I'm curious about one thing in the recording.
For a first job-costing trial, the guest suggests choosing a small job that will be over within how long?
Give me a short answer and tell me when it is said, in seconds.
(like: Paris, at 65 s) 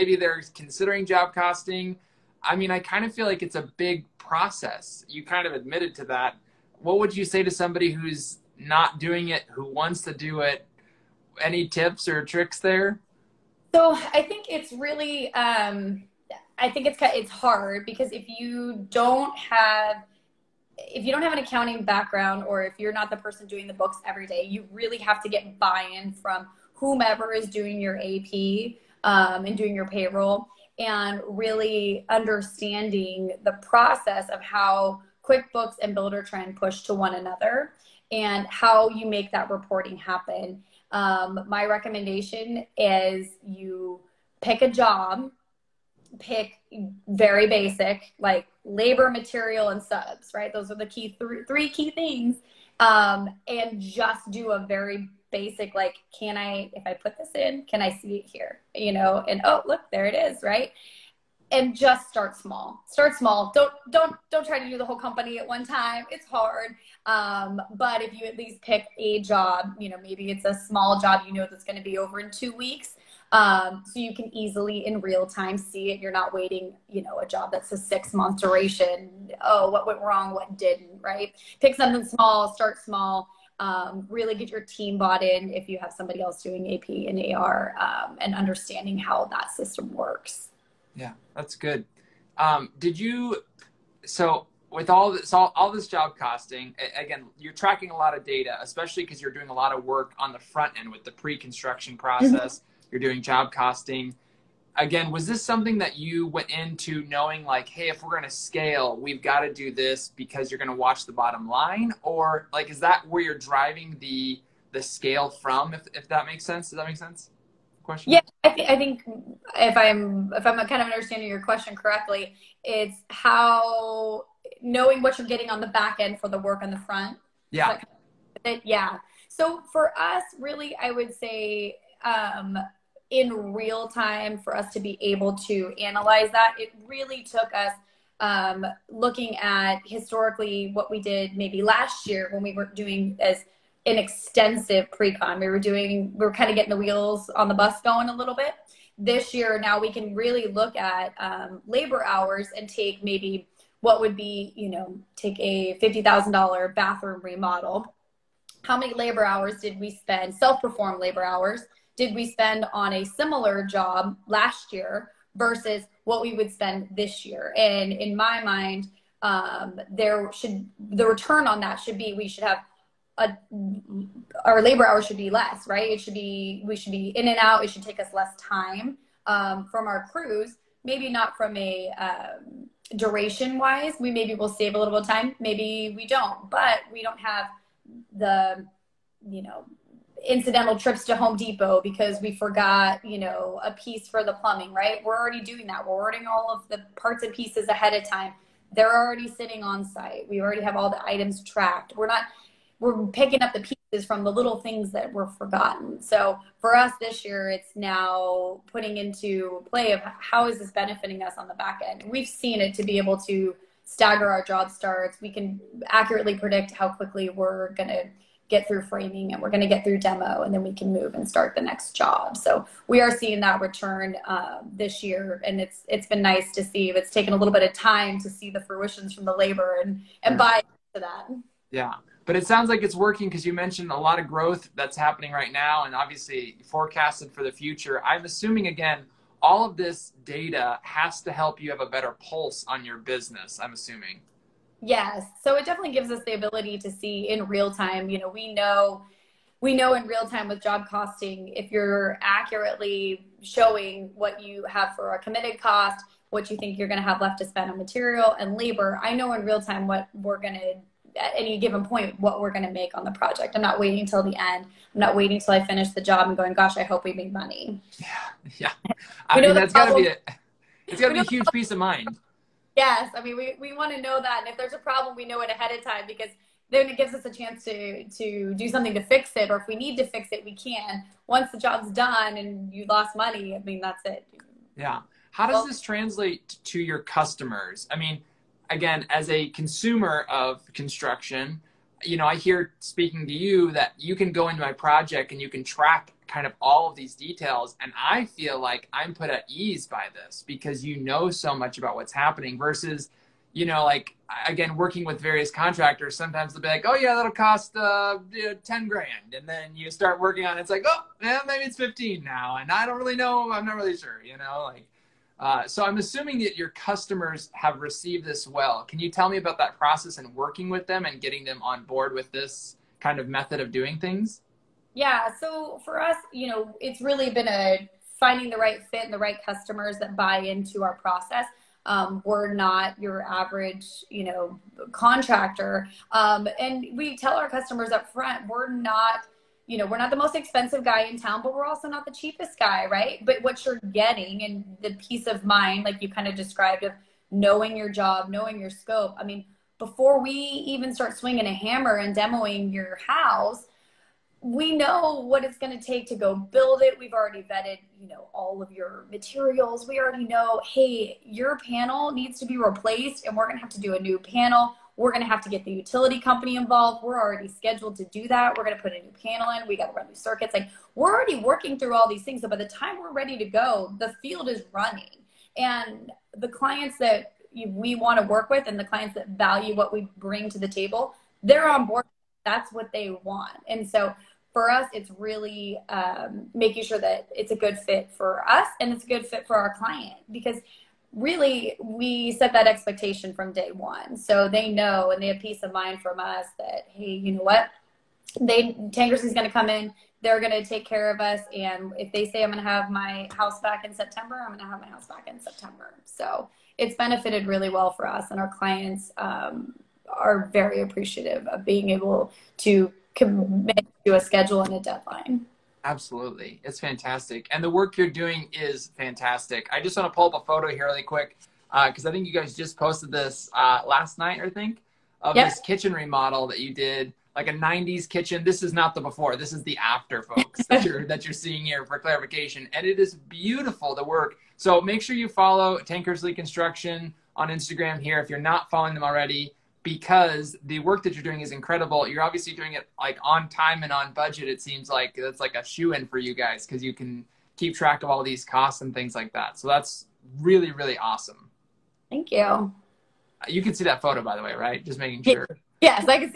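two weeks, at 72 s.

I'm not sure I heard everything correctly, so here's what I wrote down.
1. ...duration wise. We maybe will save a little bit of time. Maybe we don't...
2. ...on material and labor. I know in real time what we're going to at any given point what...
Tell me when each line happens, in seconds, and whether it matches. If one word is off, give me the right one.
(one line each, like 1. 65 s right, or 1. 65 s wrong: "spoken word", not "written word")
1. 182 s right
2. 257 s right.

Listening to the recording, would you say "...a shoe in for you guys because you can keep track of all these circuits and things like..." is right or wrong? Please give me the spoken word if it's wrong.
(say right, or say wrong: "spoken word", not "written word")
wrong: "costs", not "circuits".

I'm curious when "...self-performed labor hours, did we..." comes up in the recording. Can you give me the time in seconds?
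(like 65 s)
160 s.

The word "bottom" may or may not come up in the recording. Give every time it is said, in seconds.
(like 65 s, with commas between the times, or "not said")
111 s.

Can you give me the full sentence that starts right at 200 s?
We already have all the items tracked.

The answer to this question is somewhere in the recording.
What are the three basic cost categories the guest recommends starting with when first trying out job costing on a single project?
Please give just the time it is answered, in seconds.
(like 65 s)
48 s.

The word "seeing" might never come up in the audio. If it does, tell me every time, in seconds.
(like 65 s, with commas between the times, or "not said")
223 s, 431 s.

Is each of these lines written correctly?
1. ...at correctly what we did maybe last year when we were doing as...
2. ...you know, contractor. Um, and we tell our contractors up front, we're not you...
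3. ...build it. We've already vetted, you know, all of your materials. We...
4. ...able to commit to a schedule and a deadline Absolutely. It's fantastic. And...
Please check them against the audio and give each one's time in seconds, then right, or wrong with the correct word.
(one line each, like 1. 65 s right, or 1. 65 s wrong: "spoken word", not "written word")
1. 139 s wrong: "historically", not "correctly"
2. 334 s wrong: "customers", not "contractors"
3. 356 s right
4. 411 s right.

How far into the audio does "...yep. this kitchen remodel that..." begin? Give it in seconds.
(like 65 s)
425 s.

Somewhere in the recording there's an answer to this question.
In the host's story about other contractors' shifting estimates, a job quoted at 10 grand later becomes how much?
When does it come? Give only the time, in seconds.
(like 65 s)
311 s.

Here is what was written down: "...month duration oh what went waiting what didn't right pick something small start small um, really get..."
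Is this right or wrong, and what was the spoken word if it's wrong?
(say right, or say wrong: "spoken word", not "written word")
wrong: "wrong", not "waiting".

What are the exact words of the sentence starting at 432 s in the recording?
And it is beautiful, the work.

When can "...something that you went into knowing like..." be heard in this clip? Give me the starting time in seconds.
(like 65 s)
105 s.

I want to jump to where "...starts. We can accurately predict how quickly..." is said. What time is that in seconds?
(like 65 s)
214 s.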